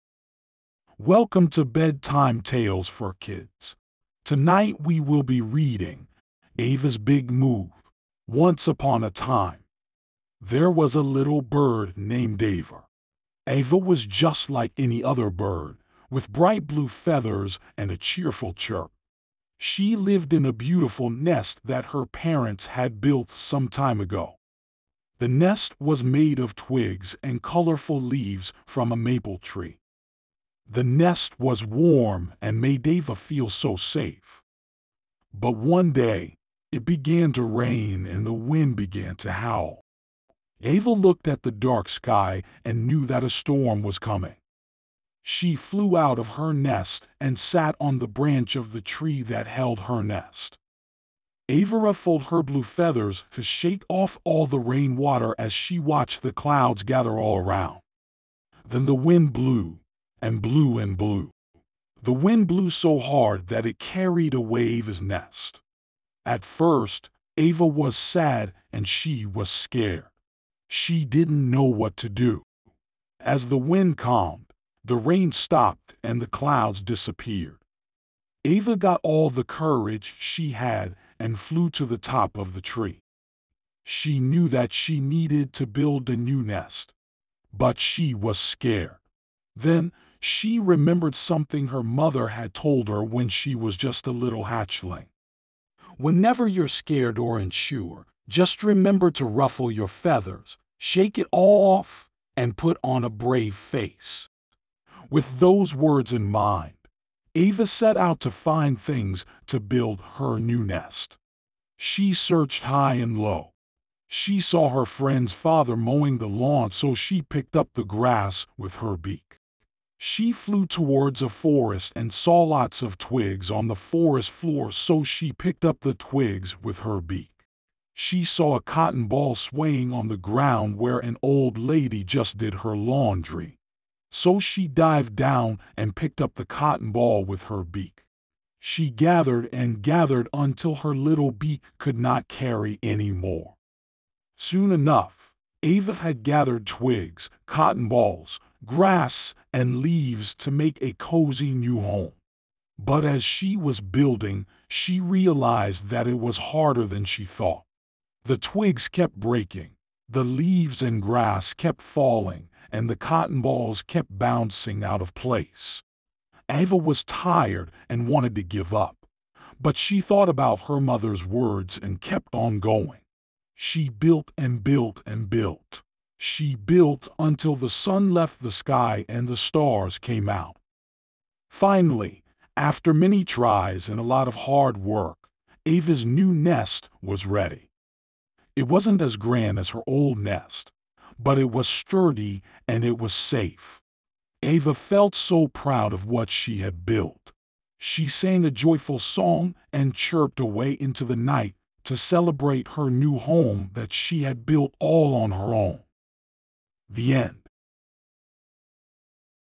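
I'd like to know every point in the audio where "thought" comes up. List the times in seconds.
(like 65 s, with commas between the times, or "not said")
157 s, 170 s.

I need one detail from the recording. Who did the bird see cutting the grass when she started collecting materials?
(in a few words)
her friend's father.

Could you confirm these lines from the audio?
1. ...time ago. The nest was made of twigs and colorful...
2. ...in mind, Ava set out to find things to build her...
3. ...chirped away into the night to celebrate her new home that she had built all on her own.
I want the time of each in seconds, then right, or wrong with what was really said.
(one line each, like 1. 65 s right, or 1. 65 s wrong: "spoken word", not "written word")
1. 23 s right
2. 106 s right
3. 199 s right.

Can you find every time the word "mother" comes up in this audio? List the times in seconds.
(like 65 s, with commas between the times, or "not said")
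91 s, 170 s.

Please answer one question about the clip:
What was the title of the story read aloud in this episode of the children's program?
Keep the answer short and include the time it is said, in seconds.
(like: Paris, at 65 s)
Ava's Big Move, at 6 s.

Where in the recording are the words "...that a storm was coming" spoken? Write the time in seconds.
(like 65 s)
43 s.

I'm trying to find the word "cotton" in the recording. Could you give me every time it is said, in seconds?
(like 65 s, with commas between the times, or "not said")
128 s, 136 s, 147 s, 162 s.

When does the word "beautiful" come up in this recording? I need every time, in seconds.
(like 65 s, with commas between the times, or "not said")
20 s.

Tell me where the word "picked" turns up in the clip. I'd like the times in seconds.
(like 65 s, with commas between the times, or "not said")
117 s, 125 s, 135 s.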